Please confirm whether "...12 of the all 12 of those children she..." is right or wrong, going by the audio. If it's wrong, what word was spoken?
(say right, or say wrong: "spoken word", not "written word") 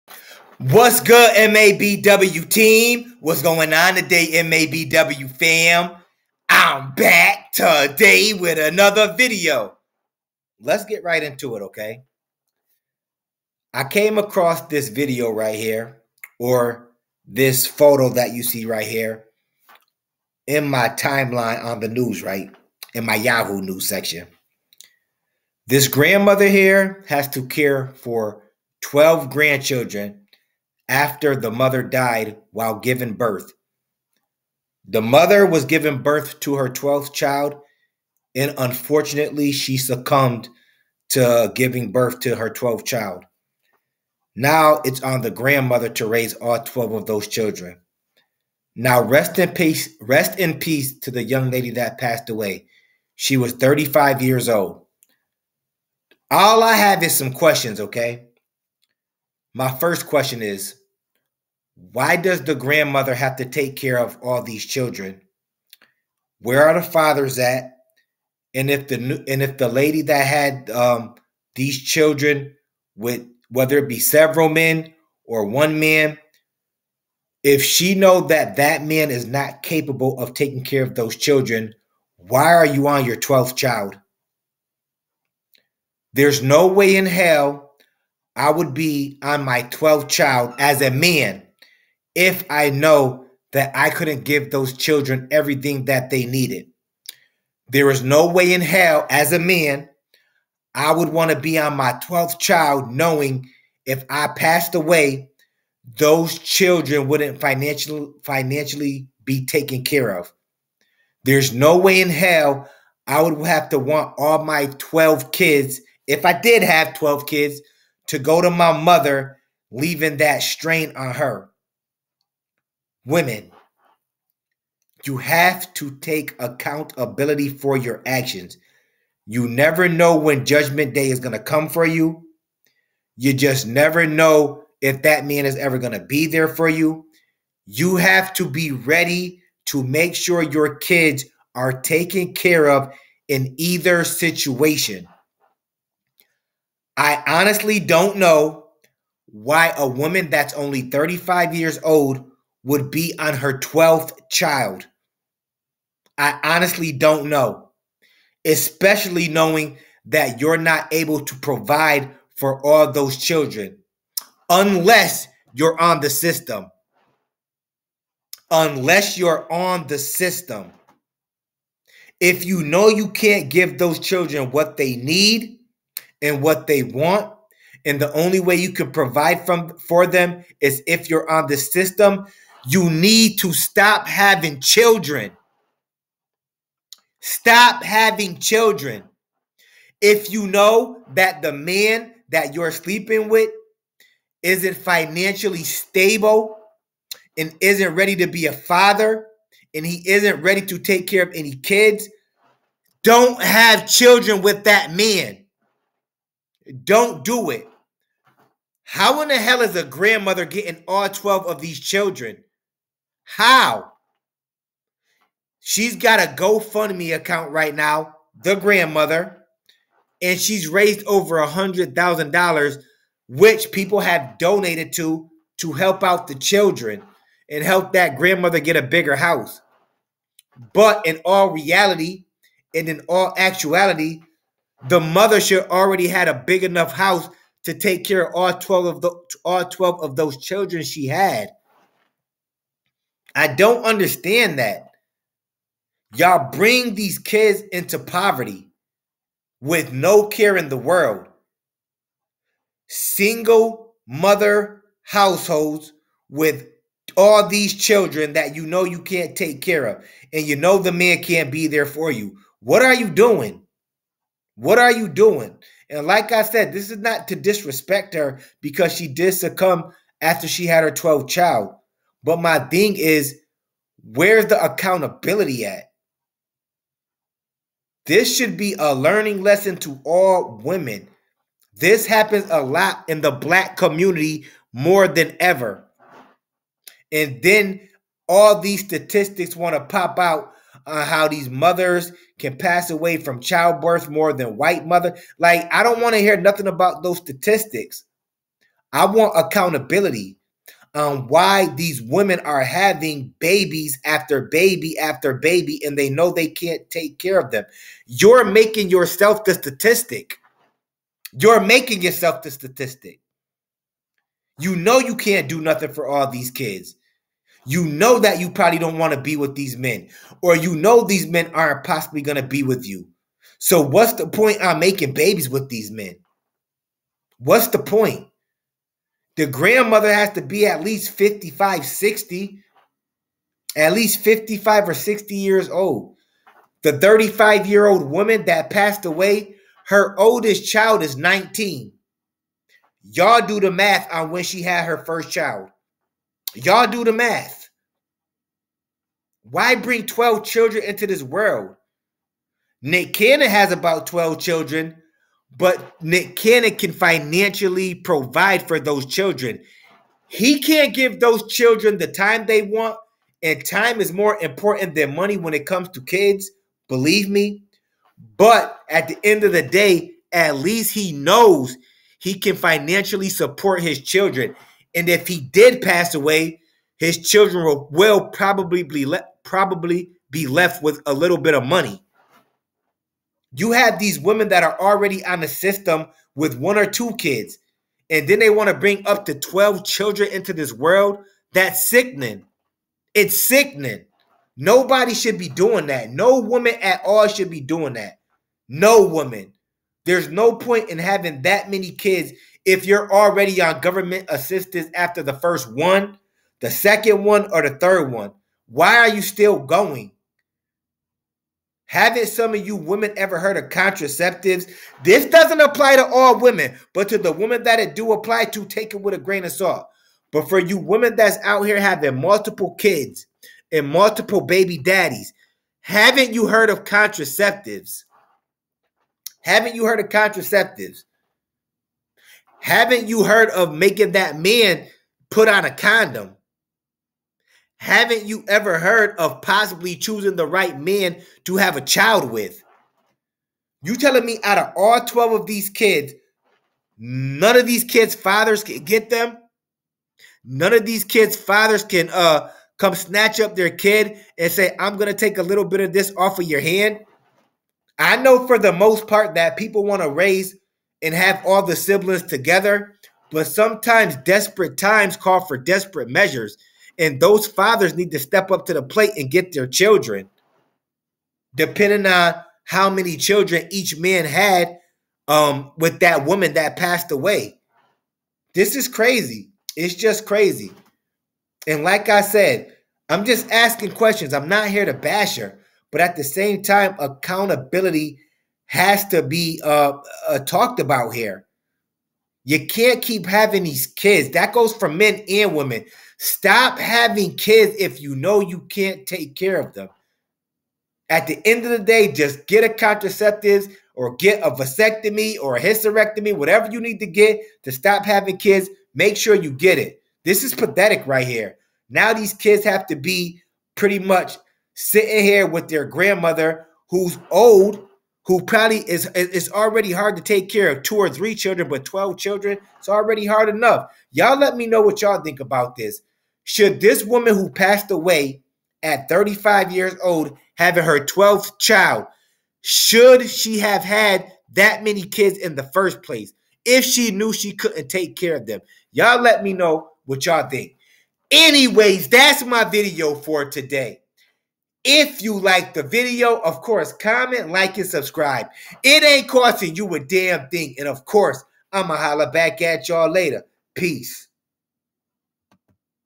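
right.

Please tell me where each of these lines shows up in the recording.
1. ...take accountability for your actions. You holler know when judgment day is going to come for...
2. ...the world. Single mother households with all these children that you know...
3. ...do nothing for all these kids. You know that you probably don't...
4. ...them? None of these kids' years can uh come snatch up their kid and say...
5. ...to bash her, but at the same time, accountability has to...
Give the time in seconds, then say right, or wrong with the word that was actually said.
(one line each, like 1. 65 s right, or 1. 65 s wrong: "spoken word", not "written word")
1. 125 s wrong: "never", not "holler"
2. 250 s right
3. 315 s right
4. 449 s wrong: "fathers", not "years"
5. 484 s right.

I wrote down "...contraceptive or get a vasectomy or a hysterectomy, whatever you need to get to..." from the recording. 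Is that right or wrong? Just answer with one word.
right.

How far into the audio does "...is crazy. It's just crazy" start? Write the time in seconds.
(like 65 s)
478 s.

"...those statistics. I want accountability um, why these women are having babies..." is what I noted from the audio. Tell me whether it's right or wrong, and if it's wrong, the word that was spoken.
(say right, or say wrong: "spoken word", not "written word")
right.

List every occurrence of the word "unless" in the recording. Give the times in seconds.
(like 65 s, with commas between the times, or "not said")
164 s, 168 s.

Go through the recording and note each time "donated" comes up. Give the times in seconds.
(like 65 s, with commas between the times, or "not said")
224 s.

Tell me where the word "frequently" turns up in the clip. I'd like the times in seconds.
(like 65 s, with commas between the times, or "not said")
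not said.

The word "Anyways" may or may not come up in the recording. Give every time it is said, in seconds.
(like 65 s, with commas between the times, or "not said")
541 s.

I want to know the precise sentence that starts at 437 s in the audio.
Haven't you ever heard of possibly choosing the right man to have a child with?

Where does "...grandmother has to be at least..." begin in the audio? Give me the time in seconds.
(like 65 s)
329 s.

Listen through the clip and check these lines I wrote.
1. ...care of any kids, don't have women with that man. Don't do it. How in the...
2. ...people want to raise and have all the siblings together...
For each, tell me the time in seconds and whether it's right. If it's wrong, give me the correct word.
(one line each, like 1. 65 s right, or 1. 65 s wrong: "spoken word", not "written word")
1. 201 s wrong: "children", not "women"
2. 459 s right.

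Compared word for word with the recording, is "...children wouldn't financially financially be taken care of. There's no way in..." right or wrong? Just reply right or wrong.
right.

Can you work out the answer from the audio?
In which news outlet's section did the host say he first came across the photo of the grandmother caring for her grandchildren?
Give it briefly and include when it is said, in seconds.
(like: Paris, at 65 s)
Yahoo News, at 23 s.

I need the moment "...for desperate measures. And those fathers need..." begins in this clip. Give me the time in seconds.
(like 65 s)
465 s.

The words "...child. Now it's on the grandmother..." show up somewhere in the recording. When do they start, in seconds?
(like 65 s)
42 s.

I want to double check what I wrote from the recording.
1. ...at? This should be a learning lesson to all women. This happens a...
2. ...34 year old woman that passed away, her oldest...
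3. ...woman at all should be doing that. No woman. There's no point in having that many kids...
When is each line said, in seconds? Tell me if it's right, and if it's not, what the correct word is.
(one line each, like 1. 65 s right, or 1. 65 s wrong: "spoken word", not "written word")
1. 275 s right
2. 336 s wrong: "35", not "34"
3. 396 s right.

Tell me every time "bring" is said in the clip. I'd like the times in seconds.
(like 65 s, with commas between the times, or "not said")
246 s, 349 s, 388 s.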